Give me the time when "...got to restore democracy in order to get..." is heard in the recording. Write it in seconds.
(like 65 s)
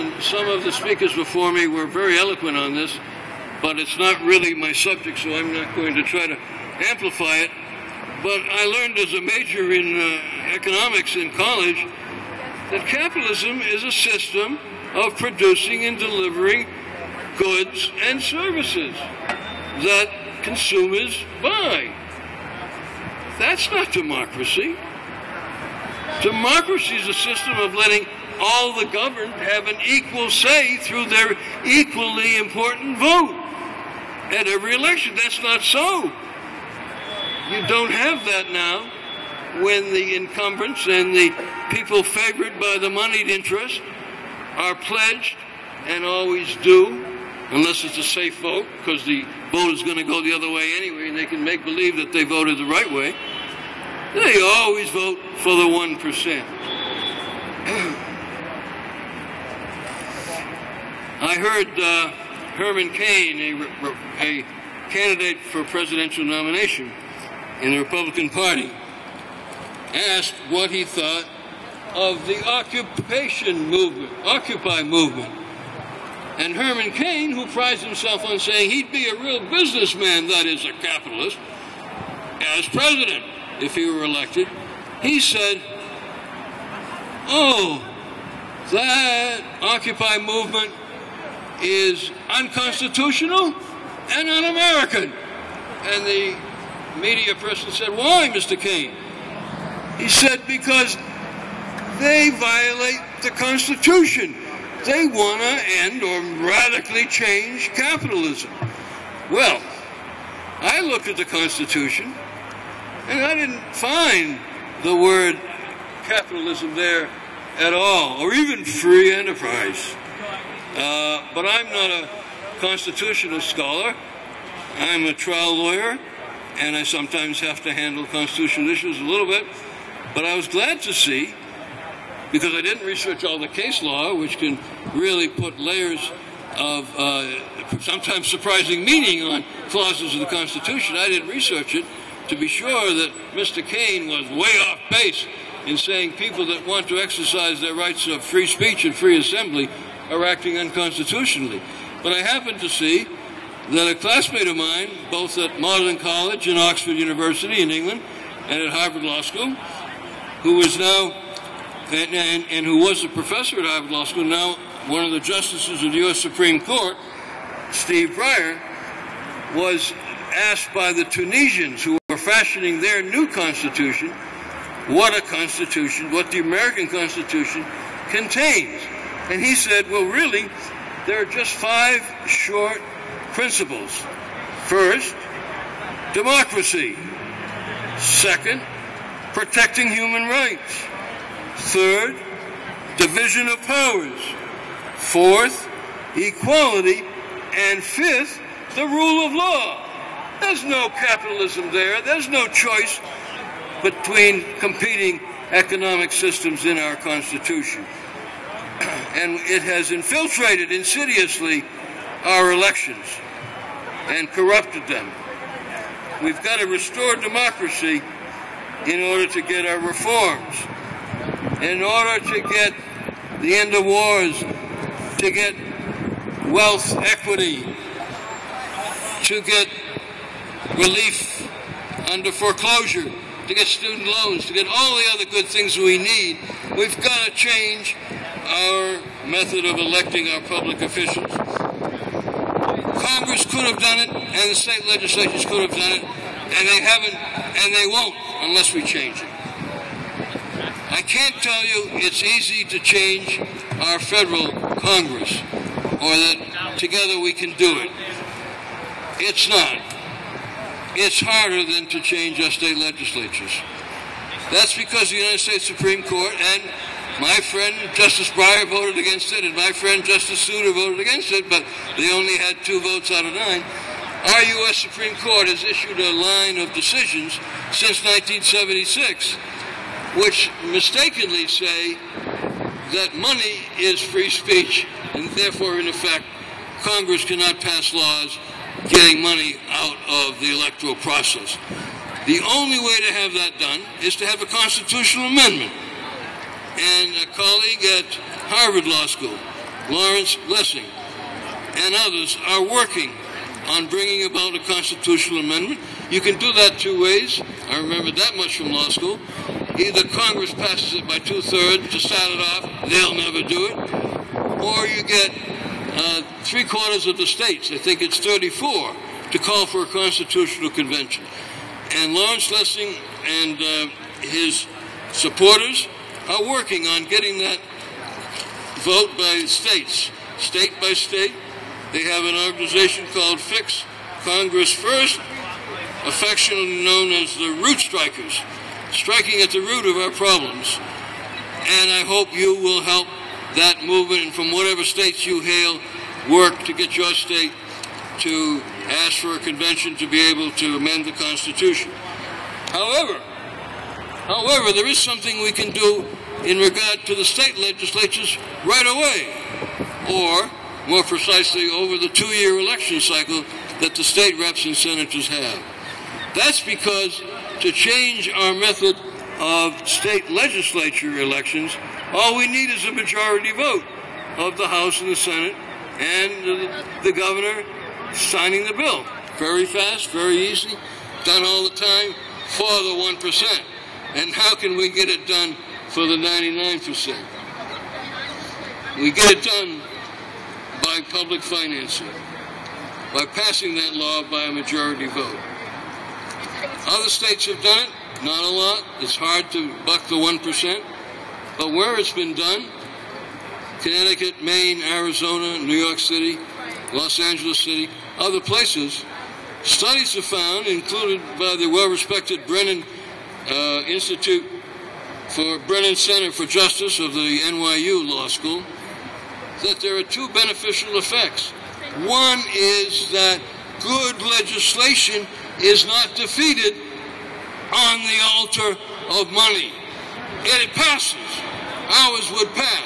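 216 s.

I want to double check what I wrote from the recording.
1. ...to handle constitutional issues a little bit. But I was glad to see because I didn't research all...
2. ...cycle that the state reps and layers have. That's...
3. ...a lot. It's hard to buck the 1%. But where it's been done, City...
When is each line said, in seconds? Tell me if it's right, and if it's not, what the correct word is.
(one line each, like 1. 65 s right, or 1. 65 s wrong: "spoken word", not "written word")
1. 127 s right
2. 362 s wrong: "senators", not "layers"
3. 398 s wrong: "Connecticut", not "City".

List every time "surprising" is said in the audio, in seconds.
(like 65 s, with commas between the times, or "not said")
138 s.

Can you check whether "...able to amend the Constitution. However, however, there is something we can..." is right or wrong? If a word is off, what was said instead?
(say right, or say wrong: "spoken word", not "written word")
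right.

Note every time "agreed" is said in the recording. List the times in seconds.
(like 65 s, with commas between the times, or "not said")
not said.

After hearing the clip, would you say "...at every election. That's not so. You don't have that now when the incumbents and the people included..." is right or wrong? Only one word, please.
wrong.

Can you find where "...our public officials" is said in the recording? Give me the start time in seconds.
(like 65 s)
240 s.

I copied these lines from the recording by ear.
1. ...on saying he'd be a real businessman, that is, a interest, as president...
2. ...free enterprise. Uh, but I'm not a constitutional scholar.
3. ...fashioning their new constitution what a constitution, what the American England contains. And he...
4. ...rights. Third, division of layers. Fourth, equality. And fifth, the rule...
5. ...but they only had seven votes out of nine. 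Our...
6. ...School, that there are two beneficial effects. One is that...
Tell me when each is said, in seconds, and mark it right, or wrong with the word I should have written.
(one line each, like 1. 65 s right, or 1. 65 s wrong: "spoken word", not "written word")
1. 78 s wrong: "capitalist", not "interest"
2. 118 s right
3. 172 s wrong: "Constitution", not "England"
4. 190 s wrong: "powers", not "layers"
5. 271 s wrong: "two", not "seven"
6. 418 s right.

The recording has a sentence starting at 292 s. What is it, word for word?
The only way to have that done is to have a constitutional amendment.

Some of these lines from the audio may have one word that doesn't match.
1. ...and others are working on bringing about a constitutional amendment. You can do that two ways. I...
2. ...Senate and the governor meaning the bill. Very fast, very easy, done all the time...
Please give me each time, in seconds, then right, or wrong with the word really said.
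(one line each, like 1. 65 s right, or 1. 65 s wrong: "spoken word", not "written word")
1. 301 s right
2. 375 s wrong: "signing", not "meaning".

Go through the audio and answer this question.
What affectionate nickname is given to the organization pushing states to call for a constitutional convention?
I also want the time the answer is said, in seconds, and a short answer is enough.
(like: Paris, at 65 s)
Root Strikers, at 337 s.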